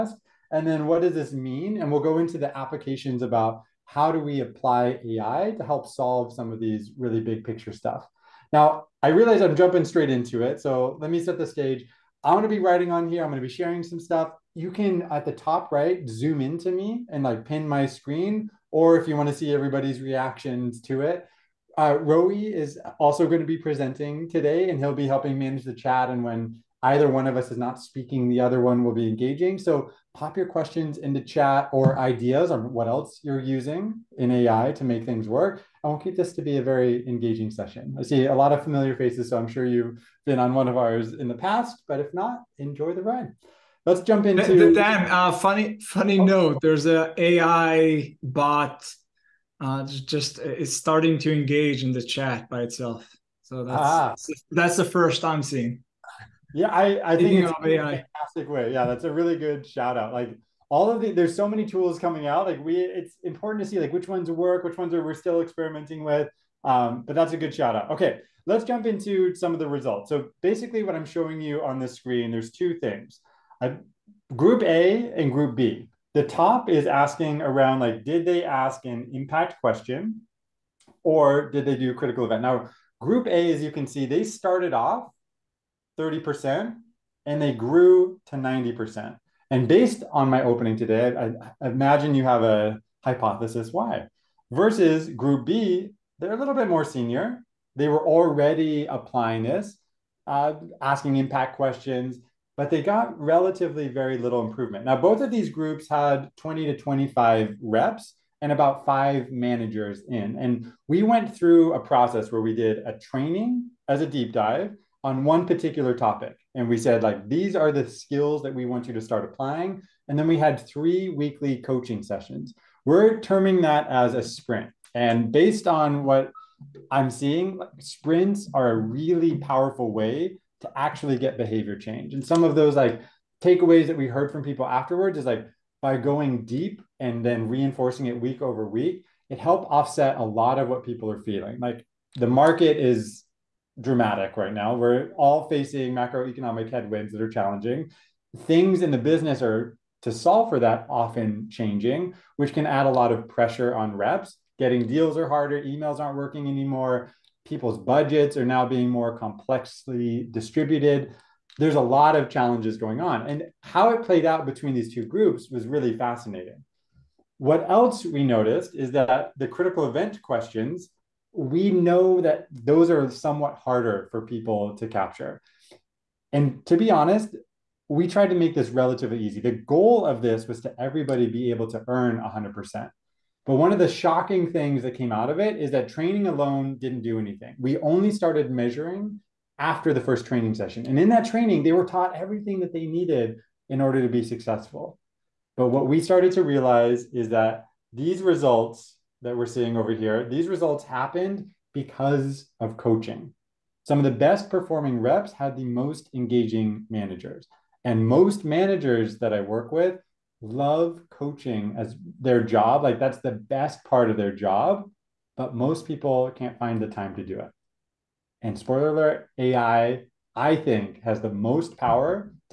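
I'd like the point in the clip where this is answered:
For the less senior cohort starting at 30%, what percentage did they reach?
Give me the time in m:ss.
1:28.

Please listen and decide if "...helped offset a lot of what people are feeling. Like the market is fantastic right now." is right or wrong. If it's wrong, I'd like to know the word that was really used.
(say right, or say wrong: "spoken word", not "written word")
wrong: "dramatic", not "fantastic".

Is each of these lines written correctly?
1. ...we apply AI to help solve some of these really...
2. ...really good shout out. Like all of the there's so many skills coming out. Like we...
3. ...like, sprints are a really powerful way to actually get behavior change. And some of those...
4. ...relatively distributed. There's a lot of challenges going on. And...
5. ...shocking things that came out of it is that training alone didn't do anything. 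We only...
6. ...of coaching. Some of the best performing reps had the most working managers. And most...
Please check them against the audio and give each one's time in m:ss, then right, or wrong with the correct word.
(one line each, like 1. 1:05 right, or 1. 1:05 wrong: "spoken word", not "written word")
1. 0:04 right
2. 0:59 wrong: "tools", not "skills"
3. 2:07 right
4. 2:39 wrong: "complexly", not "relatively"
5. 3:03 right
6. 3:22 wrong: "engaging", not "working".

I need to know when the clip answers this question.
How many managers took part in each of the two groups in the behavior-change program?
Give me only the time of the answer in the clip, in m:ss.
1:48.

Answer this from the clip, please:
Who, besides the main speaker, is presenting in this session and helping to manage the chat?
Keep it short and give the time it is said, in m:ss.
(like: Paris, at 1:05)
Roe, at 0:21.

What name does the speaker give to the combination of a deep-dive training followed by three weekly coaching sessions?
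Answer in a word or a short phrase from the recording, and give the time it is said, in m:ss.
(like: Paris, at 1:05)
sprint, at 2:04.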